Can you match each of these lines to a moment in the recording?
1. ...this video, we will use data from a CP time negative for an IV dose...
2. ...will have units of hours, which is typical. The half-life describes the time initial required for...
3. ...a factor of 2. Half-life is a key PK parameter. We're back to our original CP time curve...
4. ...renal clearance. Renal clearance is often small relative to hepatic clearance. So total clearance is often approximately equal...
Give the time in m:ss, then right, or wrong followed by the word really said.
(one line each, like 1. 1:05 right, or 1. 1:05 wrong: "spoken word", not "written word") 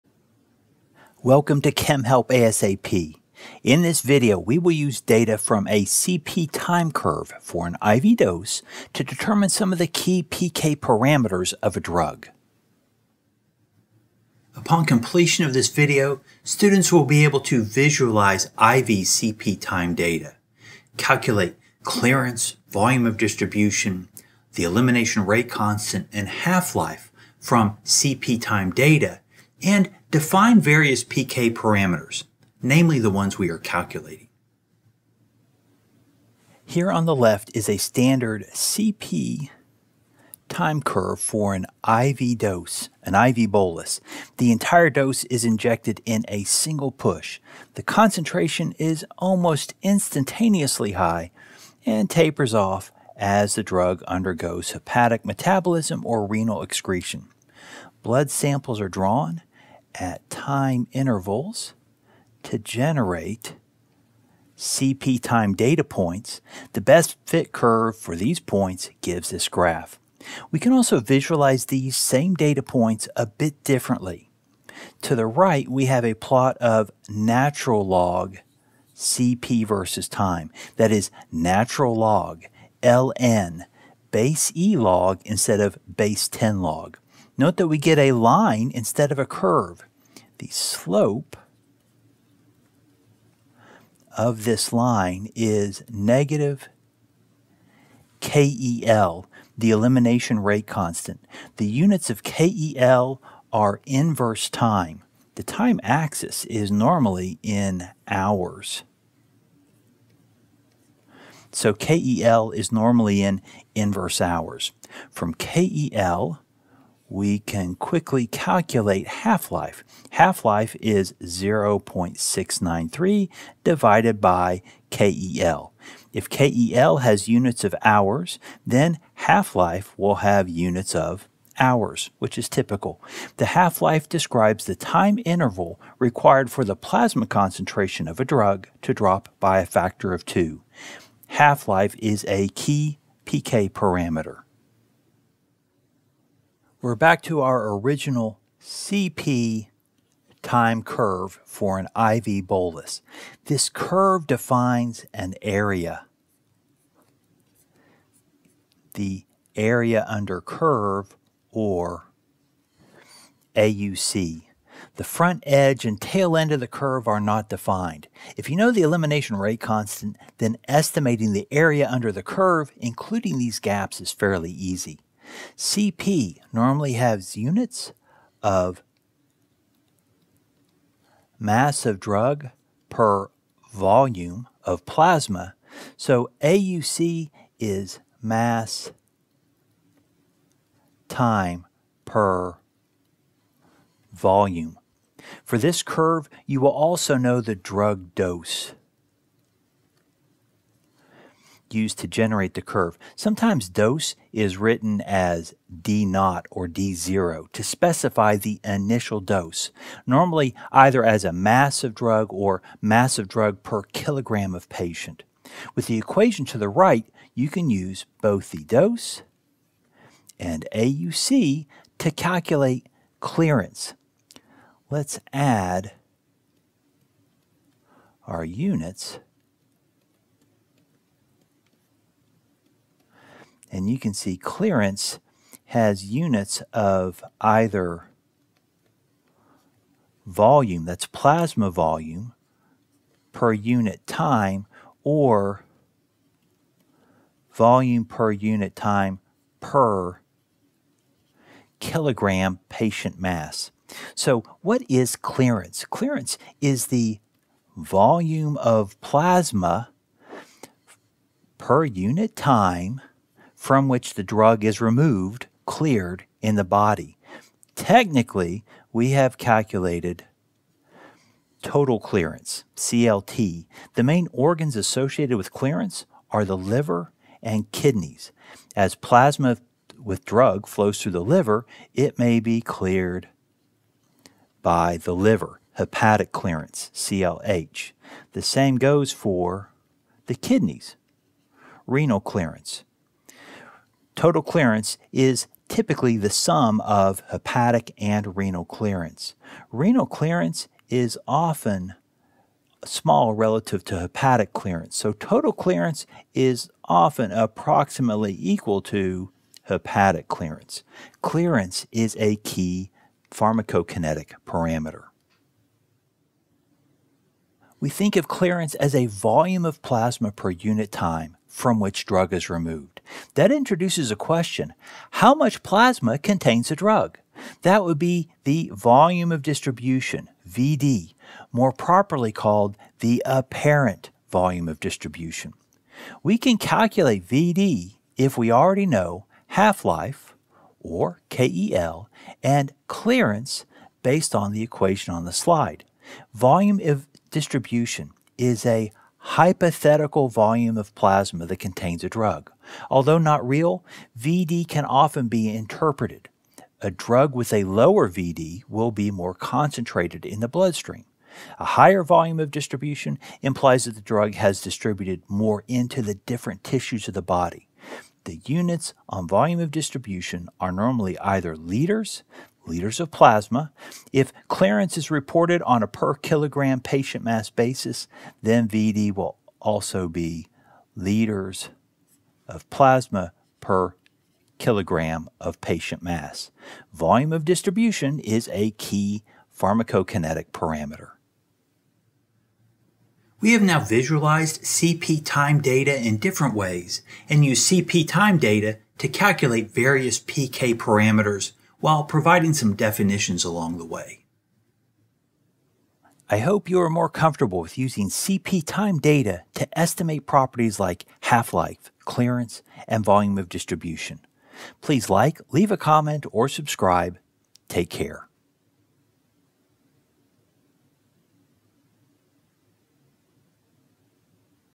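1. 0:03 wrong: "curve", not "negative"
2. 2:09 wrong: "interval", not "initial"
3. 2:19 right
4. 4:58 right.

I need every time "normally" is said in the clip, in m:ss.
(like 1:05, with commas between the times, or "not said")
1:46, 1:52, 2:56, 3:30, 6:10.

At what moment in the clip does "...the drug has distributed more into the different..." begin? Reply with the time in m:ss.
6:03.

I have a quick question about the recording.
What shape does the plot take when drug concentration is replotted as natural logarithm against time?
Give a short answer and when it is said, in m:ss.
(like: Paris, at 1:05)
A line, at 1:27.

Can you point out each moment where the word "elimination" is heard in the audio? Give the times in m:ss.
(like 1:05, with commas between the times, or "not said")
0:24, 1:39, 2:48.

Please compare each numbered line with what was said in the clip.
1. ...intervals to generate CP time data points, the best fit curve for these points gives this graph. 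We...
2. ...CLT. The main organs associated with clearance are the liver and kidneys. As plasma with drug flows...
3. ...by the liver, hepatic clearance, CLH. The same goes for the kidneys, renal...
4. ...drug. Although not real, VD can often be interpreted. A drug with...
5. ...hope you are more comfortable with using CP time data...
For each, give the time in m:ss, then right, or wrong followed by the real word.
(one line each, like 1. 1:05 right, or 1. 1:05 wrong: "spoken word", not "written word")
1. 1:00 right
2. 4:32 right
3. 4:44 right
4. 5:52 right
5. 6:46 right.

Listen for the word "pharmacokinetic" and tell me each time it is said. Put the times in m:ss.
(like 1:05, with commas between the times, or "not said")
5:13, 6:29.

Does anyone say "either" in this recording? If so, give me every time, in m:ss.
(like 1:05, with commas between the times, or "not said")
3:30, 3:57, 6:11.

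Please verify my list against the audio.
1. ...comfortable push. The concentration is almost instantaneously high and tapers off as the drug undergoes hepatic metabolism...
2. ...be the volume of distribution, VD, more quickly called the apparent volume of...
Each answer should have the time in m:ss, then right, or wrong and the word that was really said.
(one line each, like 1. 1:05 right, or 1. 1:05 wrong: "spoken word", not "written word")
1. 0:46 wrong: "single", not "comfortable"
2. 5:27 wrong: "properly", not "quickly".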